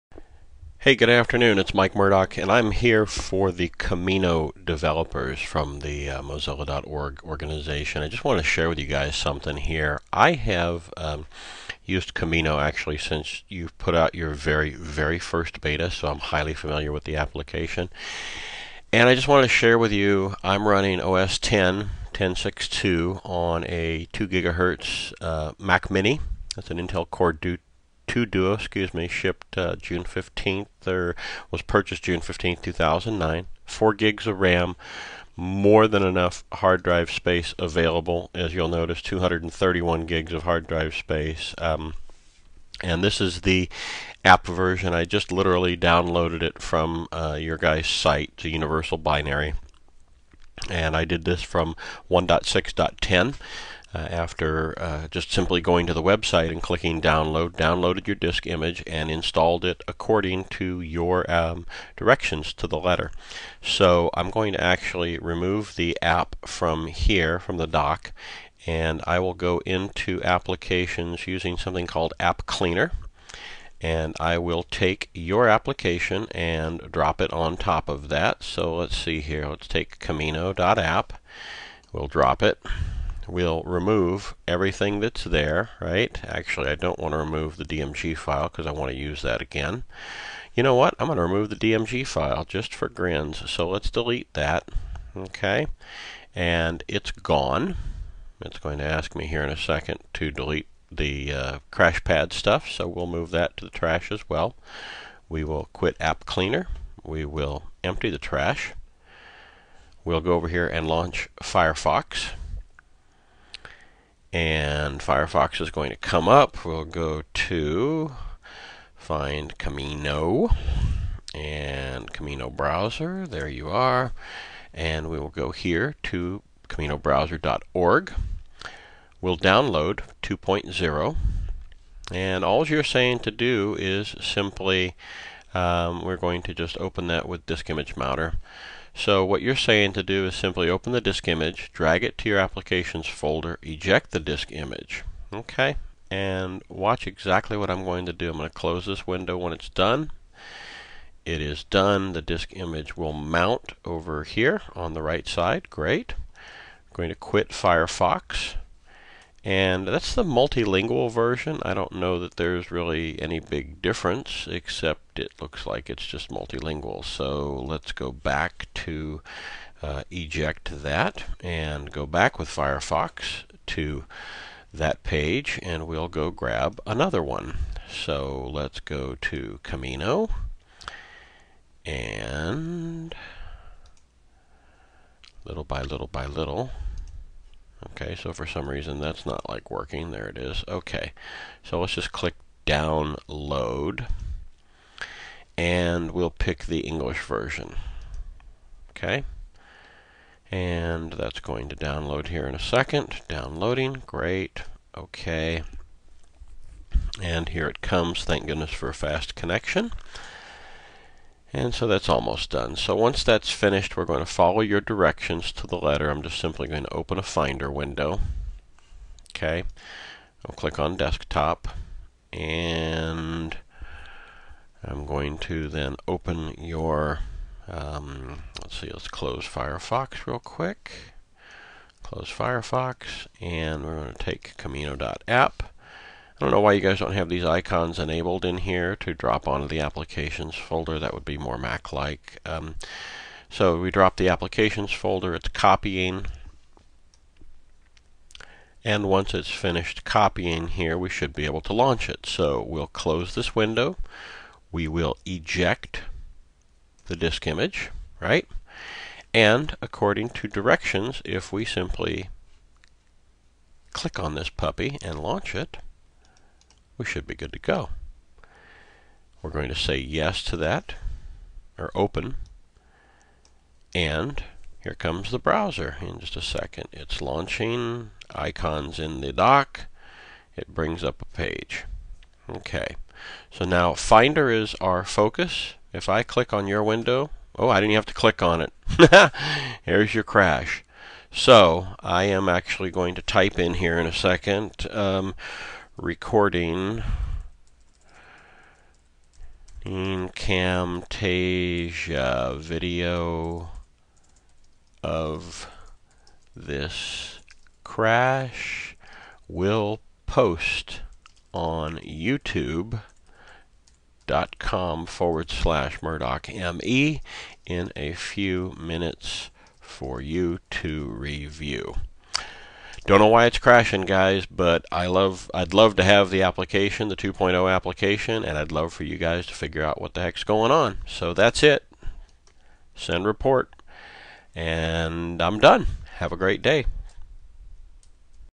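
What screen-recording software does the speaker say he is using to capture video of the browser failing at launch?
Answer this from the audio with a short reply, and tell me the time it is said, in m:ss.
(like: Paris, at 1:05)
Camtasia, at 5:00.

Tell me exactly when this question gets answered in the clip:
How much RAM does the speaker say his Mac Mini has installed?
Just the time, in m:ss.
0:33.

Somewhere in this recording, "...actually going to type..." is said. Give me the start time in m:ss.
4:52.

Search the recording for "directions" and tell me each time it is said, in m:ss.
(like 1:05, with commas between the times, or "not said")
1:01, 3:34, 4:20.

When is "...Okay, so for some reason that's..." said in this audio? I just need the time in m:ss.
3:07.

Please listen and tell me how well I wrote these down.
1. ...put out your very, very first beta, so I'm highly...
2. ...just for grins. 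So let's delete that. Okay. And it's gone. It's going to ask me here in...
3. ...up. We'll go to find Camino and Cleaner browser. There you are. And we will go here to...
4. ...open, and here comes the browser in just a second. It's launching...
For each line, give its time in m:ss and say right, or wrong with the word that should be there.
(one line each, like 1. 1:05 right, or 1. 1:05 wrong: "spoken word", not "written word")
1. 0:13 right
2. 1:32 right
3. 1:56 wrong: "Camino", not "Cleaner"
4. 4:31 right.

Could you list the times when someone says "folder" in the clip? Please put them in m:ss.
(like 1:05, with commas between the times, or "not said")
2:23, 4:00, 4:04.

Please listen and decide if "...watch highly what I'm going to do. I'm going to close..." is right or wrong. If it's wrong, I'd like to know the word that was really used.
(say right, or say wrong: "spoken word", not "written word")
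wrong: "exactly", not "highly".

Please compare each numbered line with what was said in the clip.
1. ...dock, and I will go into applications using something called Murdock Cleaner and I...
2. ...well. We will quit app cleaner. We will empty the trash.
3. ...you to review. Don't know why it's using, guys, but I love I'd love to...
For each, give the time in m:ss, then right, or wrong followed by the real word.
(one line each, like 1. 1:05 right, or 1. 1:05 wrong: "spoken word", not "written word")
1. 1:07 wrong: "App", not "Murdock"
2. 1:44 right
3. 5:20 wrong: "crashing", not "using".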